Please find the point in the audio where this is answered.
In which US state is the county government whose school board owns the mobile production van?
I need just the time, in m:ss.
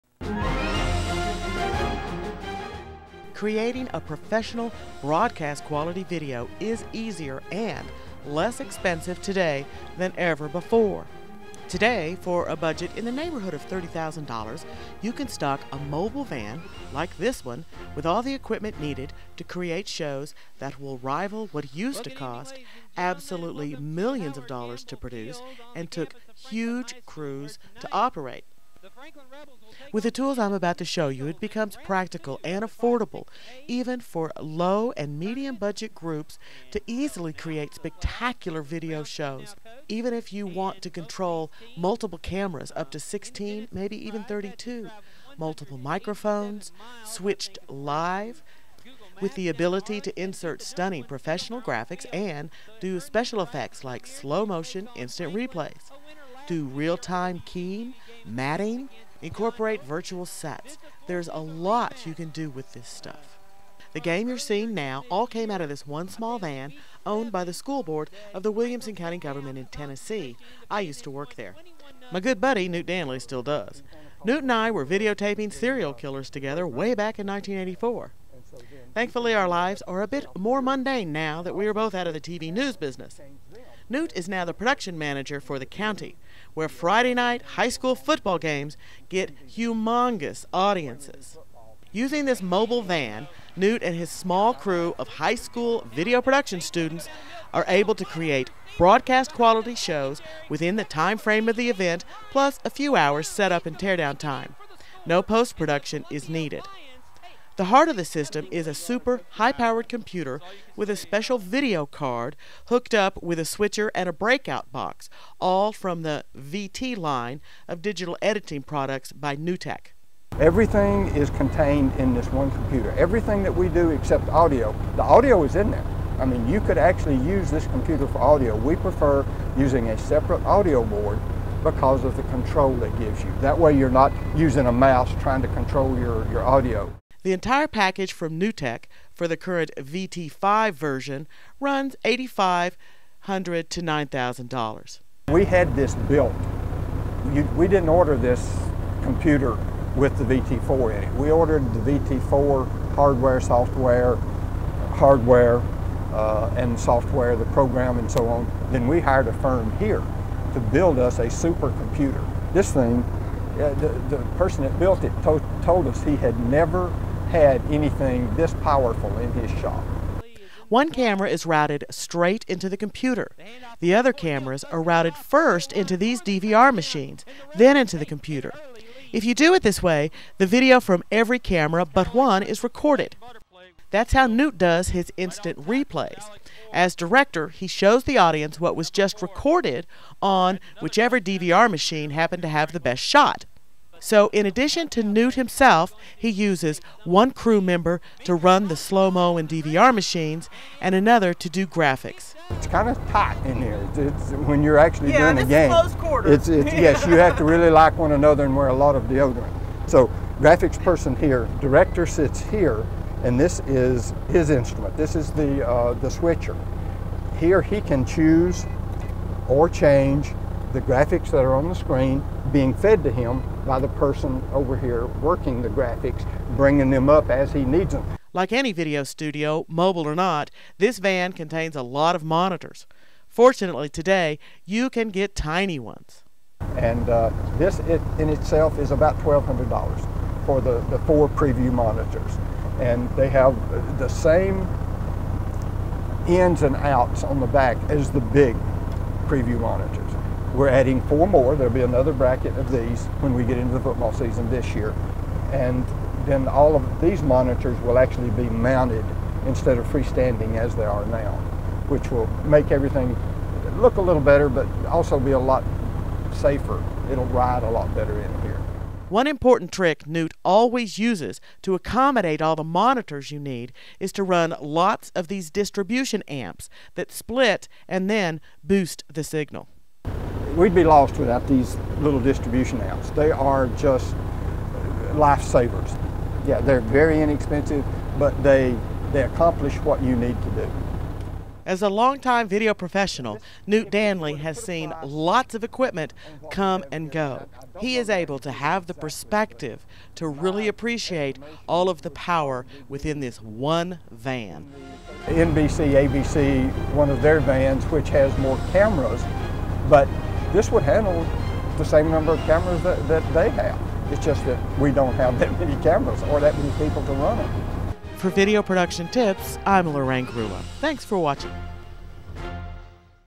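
1:09.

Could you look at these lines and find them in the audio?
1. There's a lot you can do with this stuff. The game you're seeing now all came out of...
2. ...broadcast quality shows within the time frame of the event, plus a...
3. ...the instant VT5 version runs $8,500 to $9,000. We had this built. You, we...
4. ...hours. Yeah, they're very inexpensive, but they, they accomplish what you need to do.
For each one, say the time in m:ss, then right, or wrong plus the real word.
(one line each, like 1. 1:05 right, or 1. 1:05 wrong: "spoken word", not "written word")
1. 1:01 right
2. 1:38 right
3. 2:19 wrong: "current", not "instant"
4. 4:45 wrong: "lifesavers", not "hours".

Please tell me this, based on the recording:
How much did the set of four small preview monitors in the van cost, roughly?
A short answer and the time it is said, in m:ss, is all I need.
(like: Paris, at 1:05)
$1,200, at 3:59.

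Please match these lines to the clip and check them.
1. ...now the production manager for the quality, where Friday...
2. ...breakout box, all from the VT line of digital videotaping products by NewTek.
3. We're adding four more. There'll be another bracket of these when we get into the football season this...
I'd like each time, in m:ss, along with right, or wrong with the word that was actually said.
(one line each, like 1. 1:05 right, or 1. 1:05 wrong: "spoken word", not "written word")
1. 1:24 wrong: "county", not "quality"
2. 1:54 wrong: "editing", not "videotaping"
3. 4:10 right.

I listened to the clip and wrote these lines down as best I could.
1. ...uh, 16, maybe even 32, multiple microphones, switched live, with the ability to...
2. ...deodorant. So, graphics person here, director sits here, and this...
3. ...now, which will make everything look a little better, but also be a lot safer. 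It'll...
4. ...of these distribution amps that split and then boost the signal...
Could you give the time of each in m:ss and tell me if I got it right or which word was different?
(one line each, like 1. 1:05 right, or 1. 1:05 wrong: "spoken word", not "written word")
1. 0:42 right
2. 3:29 right
3. 4:21 right
4. 4:35 right.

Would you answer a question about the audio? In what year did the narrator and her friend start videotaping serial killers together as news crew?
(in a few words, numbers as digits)
1984.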